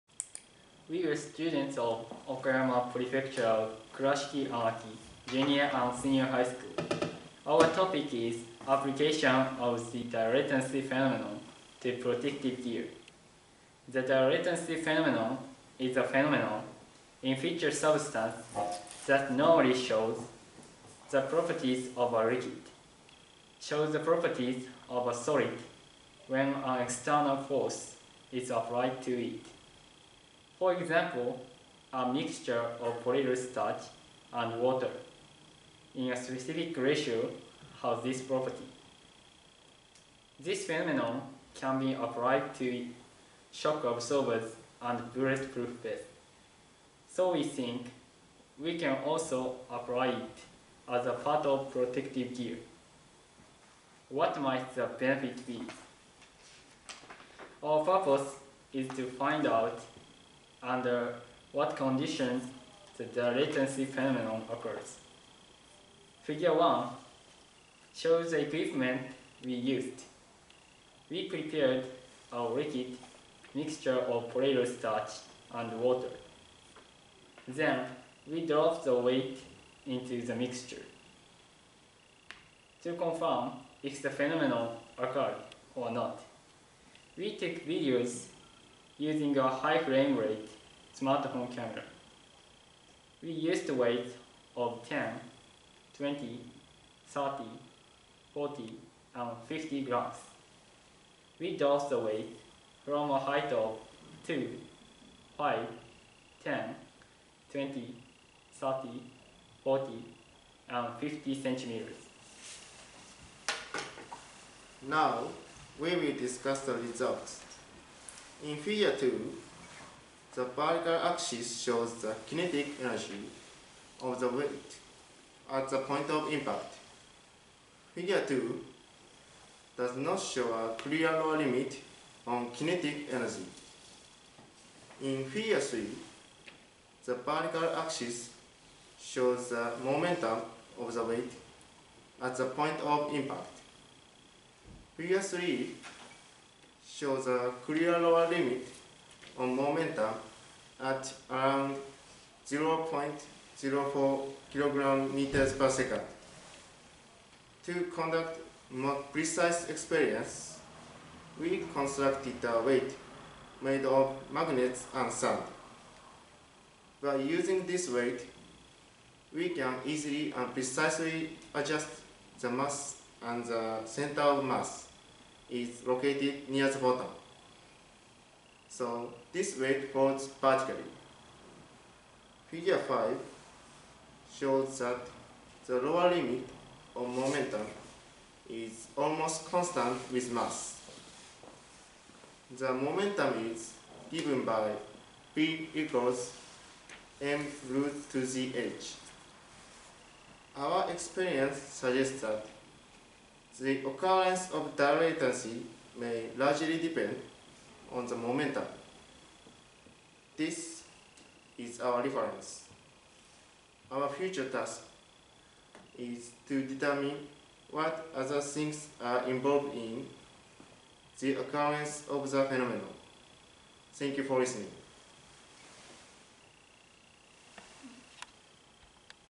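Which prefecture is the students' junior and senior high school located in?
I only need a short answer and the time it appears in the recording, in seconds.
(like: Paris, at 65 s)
Okayama, at 2 s.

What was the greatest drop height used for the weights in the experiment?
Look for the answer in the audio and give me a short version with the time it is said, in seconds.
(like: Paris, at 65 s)
50 centimeters, at 110 s.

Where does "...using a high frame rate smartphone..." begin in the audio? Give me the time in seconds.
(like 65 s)
88 s.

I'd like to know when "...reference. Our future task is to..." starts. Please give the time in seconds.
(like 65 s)
212 s.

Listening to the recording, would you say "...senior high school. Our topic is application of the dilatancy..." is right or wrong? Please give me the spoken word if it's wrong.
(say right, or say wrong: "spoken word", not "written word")
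right.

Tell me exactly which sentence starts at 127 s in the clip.
Figure 2 does not show a clear lower limit on kinetic energy.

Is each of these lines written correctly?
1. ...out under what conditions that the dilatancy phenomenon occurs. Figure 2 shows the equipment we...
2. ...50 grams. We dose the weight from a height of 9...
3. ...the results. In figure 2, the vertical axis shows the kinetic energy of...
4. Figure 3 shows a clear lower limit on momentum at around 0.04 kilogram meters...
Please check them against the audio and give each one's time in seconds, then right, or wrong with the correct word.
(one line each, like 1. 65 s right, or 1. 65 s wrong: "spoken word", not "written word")
1. 59 s wrong: "1", not "2"
2. 99 s wrong: "2", not "9"
3. 116 s right
4. 144 s right.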